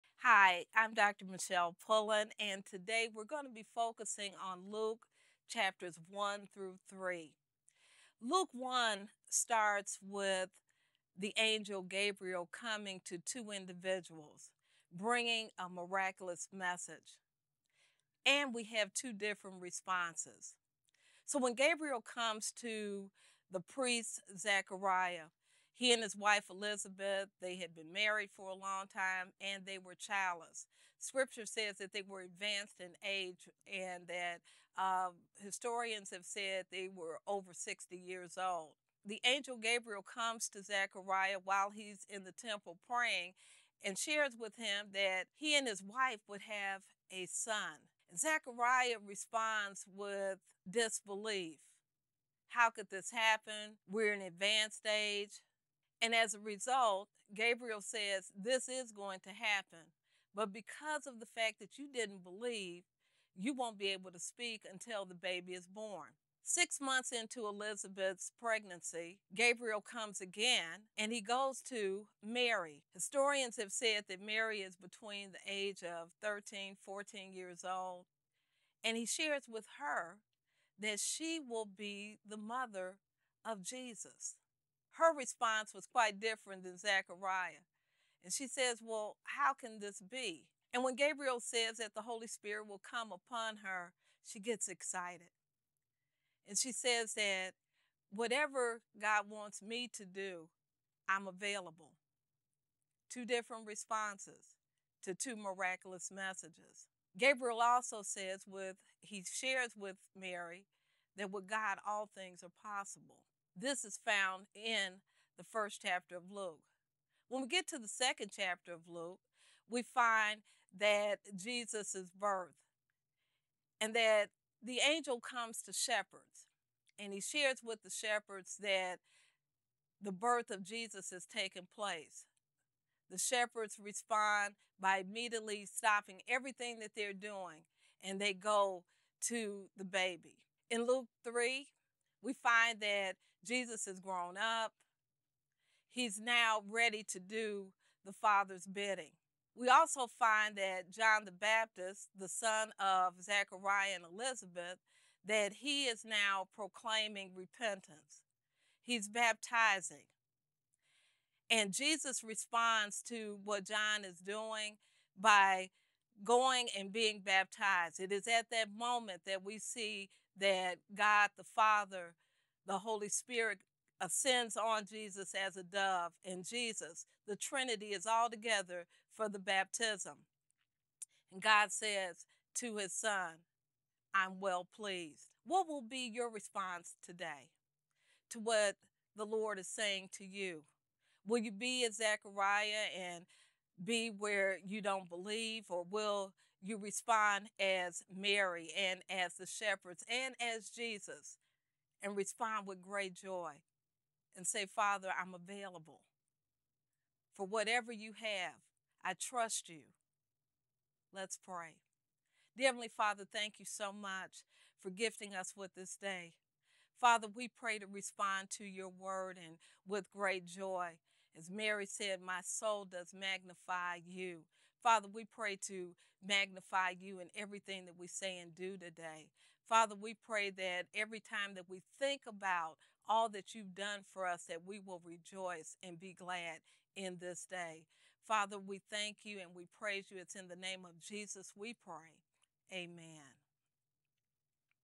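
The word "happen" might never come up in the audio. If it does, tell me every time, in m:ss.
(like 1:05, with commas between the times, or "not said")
0:53, 0:59.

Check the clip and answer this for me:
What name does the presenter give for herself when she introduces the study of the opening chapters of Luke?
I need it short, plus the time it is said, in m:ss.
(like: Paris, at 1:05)
Michele Pullen, at 0:01.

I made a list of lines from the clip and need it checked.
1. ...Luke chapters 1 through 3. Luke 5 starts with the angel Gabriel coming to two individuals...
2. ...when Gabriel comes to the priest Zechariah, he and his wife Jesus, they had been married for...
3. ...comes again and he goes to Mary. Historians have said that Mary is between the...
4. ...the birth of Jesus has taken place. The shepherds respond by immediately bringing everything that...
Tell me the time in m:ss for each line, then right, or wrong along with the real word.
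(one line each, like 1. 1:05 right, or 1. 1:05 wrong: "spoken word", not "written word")
1. 0:04 wrong: "1", not "5"
2. 0:21 wrong: "Elizabeth", not "Jesus"
3. 1:09 right
4. 2:10 wrong: "stopping", not "bringing".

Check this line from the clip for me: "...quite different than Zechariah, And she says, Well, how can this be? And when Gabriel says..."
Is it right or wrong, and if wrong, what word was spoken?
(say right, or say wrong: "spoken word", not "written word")
right.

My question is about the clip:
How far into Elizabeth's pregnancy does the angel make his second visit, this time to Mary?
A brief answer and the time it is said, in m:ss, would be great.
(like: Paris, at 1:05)
6 months, at 1:06.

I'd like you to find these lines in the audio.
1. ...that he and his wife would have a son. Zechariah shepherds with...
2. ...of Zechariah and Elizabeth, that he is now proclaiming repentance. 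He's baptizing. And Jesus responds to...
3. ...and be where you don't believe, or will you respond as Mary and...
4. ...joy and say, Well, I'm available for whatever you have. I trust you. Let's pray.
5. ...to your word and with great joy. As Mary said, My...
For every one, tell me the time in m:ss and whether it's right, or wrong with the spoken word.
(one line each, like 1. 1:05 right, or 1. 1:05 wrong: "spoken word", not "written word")
1. 0:44 wrong: "responds", not "shepherds"
2. 2:32 right
3. 3:12 right
4. 3:23 wrong: "Father", not "Well"
5. 3:38 right.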